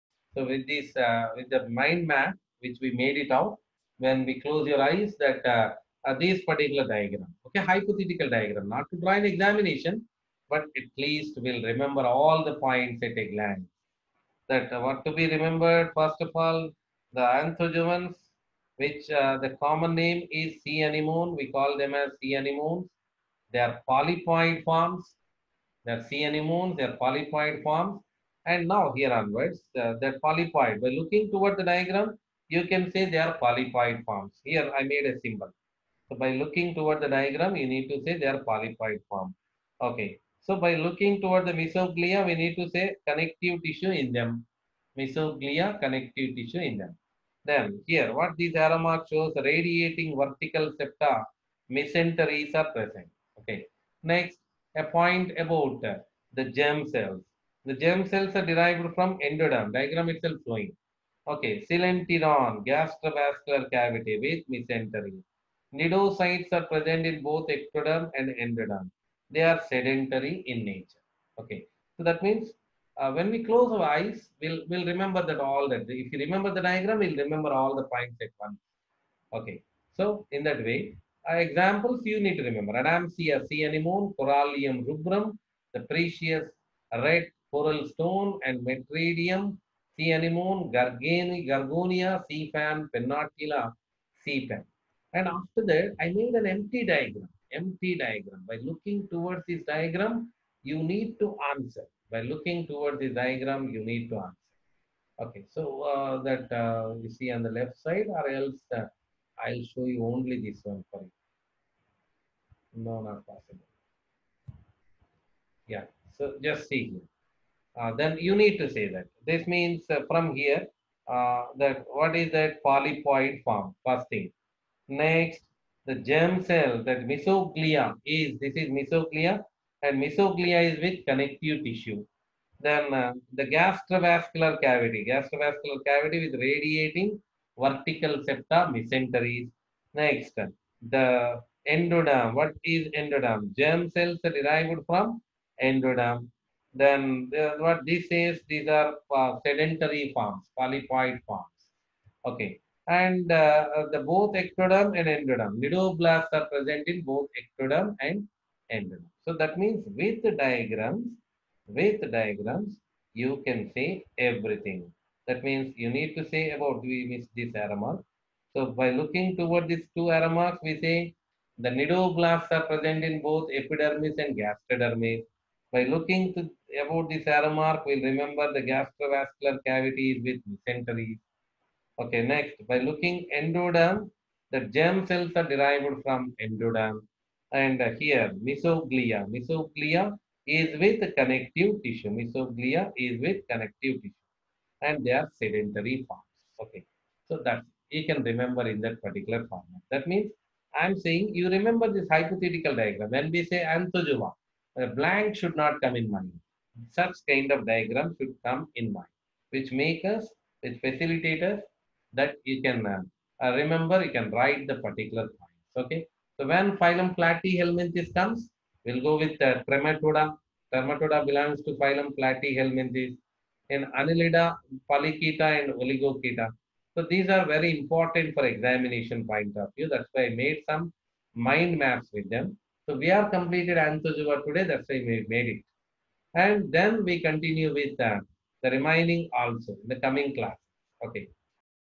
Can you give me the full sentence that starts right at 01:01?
Okay, coelenteron, gastrovascular cavity with mesentery.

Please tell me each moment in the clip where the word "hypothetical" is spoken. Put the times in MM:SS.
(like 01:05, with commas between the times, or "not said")
00:07, 03:22.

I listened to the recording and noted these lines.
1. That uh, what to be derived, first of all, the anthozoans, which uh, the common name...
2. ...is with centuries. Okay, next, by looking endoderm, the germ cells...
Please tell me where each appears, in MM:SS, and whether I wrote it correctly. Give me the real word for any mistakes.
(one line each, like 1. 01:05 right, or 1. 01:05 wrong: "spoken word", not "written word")
1. 00:14 wrong: "remembered", not "derived"
2. 03:00 right.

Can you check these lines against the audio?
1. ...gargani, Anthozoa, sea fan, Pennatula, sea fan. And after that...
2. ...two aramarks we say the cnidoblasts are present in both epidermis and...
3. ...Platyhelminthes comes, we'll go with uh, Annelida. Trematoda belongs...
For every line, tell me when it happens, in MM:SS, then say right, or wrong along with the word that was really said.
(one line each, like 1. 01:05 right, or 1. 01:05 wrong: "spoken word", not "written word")
1. 01:30 wrong: "Gorgonia", not "Anthozoa"
2. 02:49 right
3. 03:37 wrong: "Trematoda", not "Annelida".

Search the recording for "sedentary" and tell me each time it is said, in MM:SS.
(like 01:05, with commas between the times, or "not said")
01:09, 02:29, 03:15.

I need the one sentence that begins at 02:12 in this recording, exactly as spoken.
Then uh, the gastrovascular cavity, gastrovascular cavity with radiating vertical septa mesenteries.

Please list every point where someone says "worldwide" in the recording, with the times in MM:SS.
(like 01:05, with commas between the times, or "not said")
not said.